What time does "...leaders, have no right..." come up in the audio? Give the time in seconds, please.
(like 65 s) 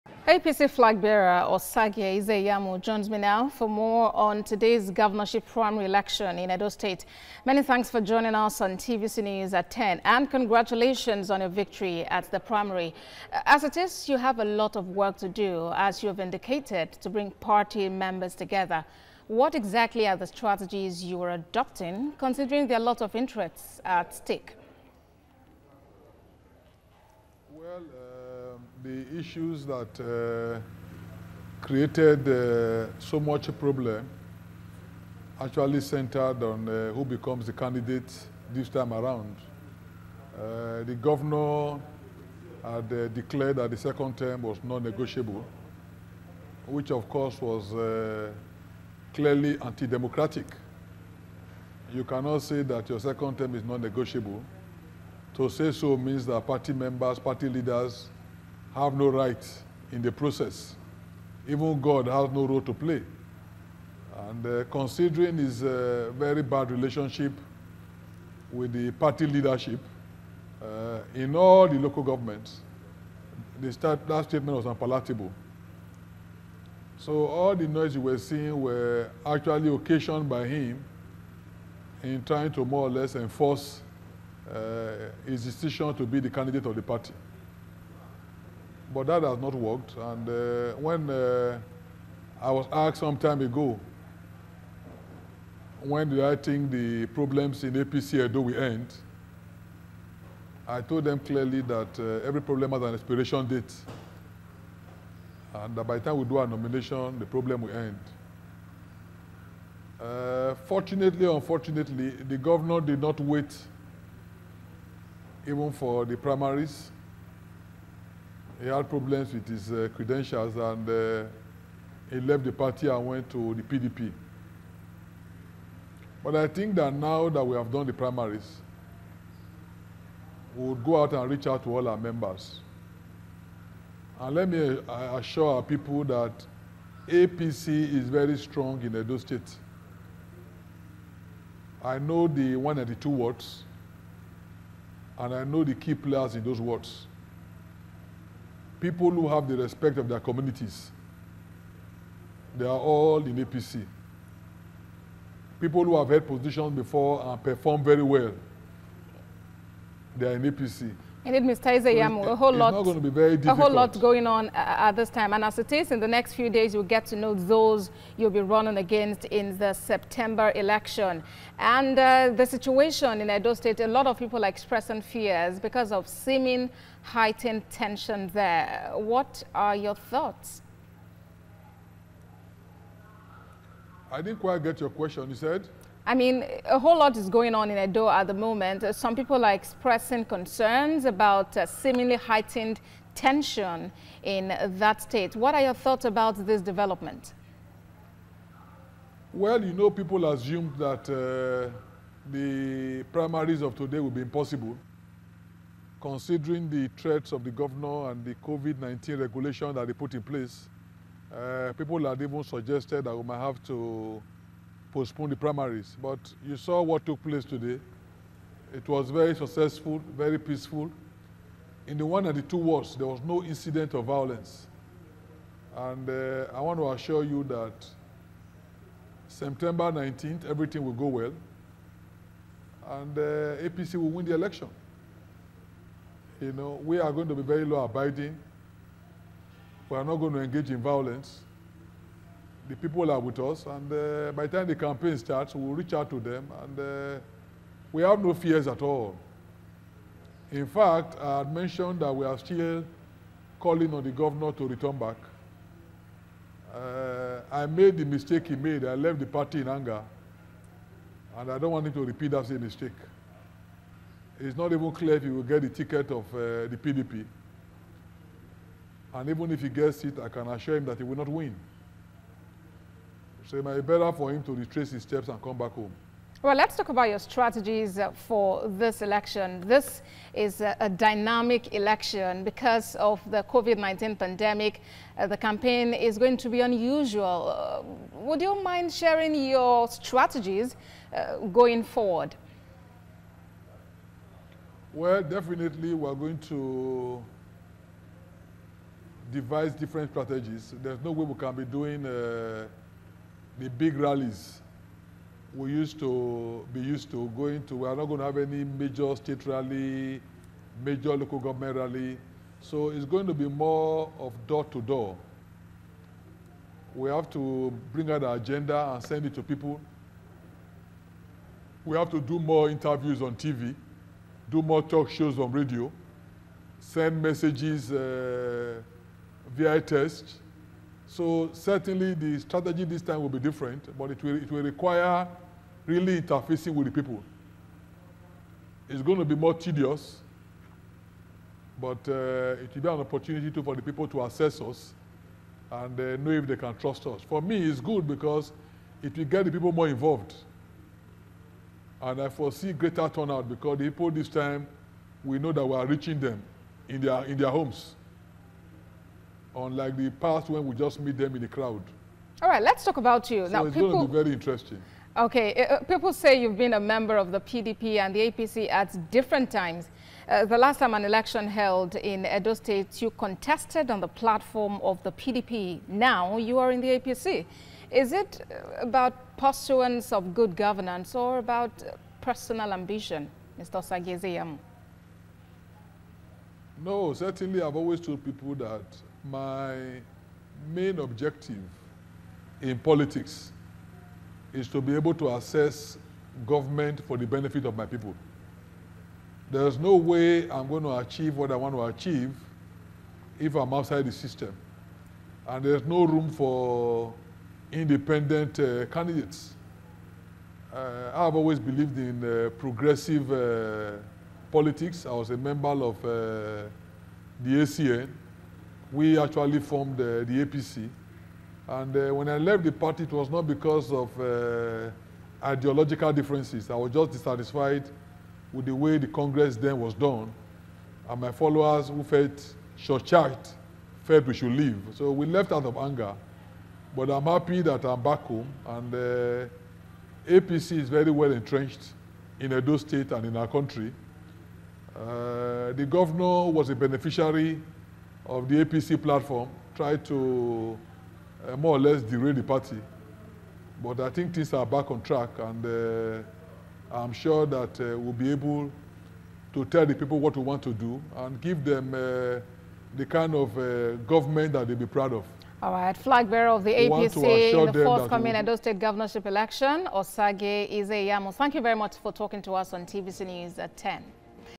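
57 s.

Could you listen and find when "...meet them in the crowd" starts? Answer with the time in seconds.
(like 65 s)
360 s.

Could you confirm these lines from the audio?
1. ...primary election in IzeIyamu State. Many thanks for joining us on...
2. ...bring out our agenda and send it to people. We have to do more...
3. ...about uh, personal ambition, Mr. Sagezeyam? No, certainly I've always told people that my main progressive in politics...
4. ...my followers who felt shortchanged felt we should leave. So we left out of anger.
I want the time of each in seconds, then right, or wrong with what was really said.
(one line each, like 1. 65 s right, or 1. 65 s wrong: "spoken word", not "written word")
1. 5 s wrong: "Edo", not "IzeIyamu"
2. 317 s right
3. 381 s wrong: "objective", not "progressive"
4. 431 s right.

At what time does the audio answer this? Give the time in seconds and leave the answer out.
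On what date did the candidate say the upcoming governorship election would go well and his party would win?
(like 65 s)
229 s.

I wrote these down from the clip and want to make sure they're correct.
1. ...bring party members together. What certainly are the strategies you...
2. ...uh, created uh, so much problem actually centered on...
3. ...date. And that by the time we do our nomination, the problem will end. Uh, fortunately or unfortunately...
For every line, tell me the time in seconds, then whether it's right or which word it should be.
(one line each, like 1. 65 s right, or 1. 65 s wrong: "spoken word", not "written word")
1. 17 s wrong: "exactly", not "certainly"
2. 30 s right
3. 103 s right.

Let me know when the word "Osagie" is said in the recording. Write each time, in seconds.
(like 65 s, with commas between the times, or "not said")
1 s, 469 s.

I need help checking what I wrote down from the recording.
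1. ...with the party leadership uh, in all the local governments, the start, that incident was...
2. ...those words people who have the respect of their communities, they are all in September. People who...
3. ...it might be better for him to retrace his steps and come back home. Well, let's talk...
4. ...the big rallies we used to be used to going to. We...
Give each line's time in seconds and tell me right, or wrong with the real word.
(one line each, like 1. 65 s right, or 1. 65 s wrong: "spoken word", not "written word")
1. 68 s wrong: "statement", not "incident"
2. 146 s wrong: "APC", not "September"
3. 273 s right
4. 303 s right.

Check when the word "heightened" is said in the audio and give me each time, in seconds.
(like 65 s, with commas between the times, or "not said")
177 s, 192 s.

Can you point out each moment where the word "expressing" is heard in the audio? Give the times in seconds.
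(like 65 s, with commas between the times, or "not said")
174 s, 189 s.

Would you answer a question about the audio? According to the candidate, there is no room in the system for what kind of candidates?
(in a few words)
independent.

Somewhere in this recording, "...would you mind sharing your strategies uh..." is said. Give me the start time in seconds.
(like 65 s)
288 s.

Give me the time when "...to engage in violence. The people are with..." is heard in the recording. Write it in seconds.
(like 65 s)
240 s.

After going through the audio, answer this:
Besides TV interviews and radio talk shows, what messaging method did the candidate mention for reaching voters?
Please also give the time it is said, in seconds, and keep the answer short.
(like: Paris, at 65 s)
text, at 329 s.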